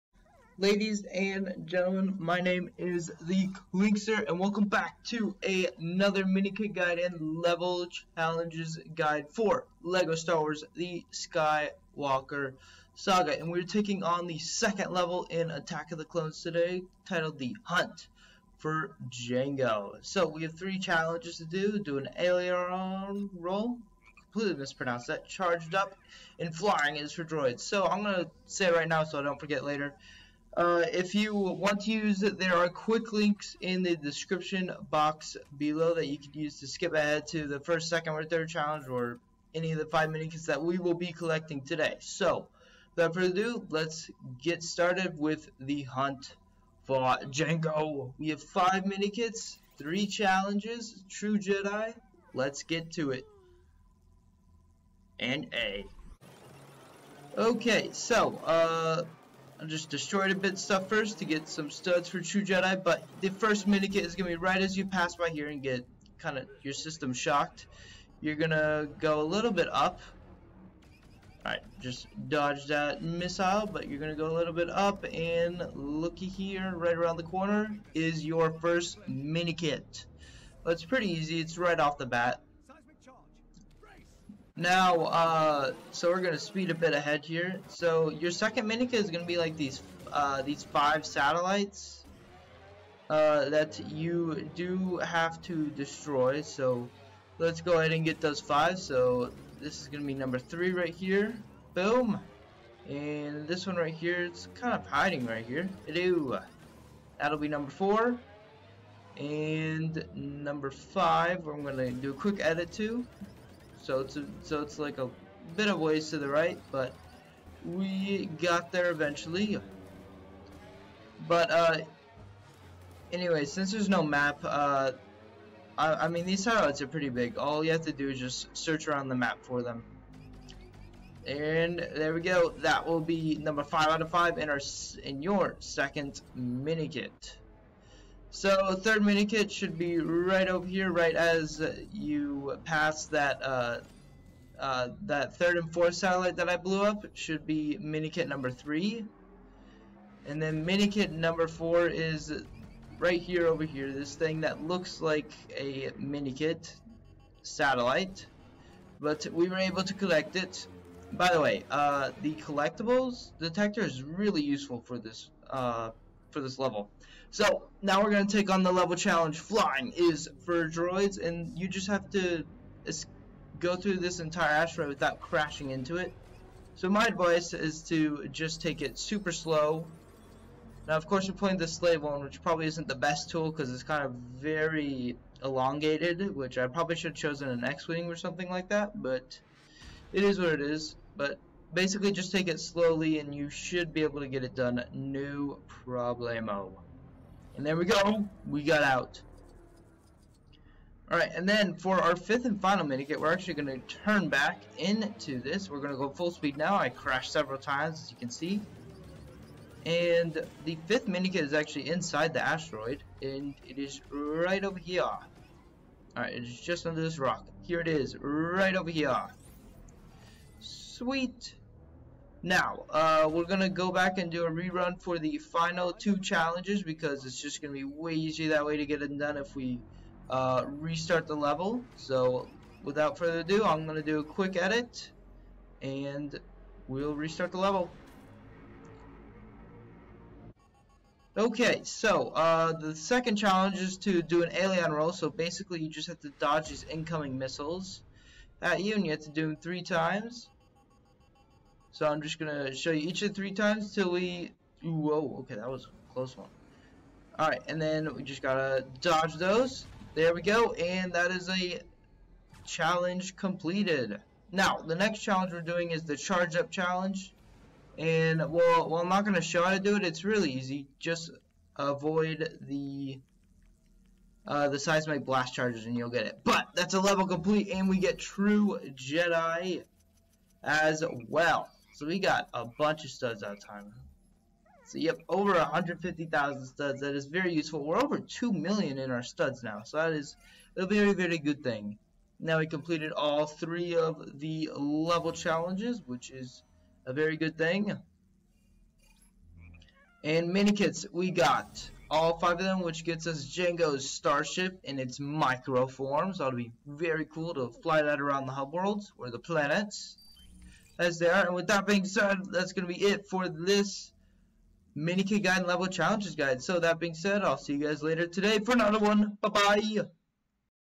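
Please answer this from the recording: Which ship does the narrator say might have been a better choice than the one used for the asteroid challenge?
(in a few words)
X-Wing.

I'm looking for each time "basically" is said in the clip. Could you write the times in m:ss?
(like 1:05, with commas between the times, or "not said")
3:11, 4:05.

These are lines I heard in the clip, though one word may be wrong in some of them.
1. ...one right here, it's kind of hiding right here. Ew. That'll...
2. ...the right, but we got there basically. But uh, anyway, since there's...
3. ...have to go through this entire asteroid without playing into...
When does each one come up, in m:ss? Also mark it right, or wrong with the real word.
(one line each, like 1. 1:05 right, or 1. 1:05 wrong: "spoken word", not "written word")
1. 1:43 right
2. 1:56 wrong: "eventually", not "basically"
3. 2:51 wrong: "crashing", not "playing".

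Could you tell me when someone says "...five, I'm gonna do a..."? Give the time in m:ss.
1:50.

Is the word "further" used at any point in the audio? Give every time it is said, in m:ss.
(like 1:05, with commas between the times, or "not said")
0:43, 3:53.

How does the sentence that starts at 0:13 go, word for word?
And we're taking on the second level in Attack of the Clones today, titled The Hunt for Jango.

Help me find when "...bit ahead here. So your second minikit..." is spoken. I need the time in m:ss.
1:26.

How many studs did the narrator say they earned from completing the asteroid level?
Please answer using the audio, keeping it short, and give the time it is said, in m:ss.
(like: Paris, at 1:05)
over 150,000, at 4:45.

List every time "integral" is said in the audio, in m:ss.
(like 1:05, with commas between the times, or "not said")
not said.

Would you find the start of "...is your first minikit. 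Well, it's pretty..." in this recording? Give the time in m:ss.
1:17.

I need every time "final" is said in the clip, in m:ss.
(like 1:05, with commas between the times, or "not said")
3:22, 3:45.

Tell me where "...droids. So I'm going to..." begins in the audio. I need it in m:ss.
0:27.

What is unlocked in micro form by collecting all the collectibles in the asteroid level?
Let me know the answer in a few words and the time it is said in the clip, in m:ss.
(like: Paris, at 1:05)
Jango's starship, at 5:03.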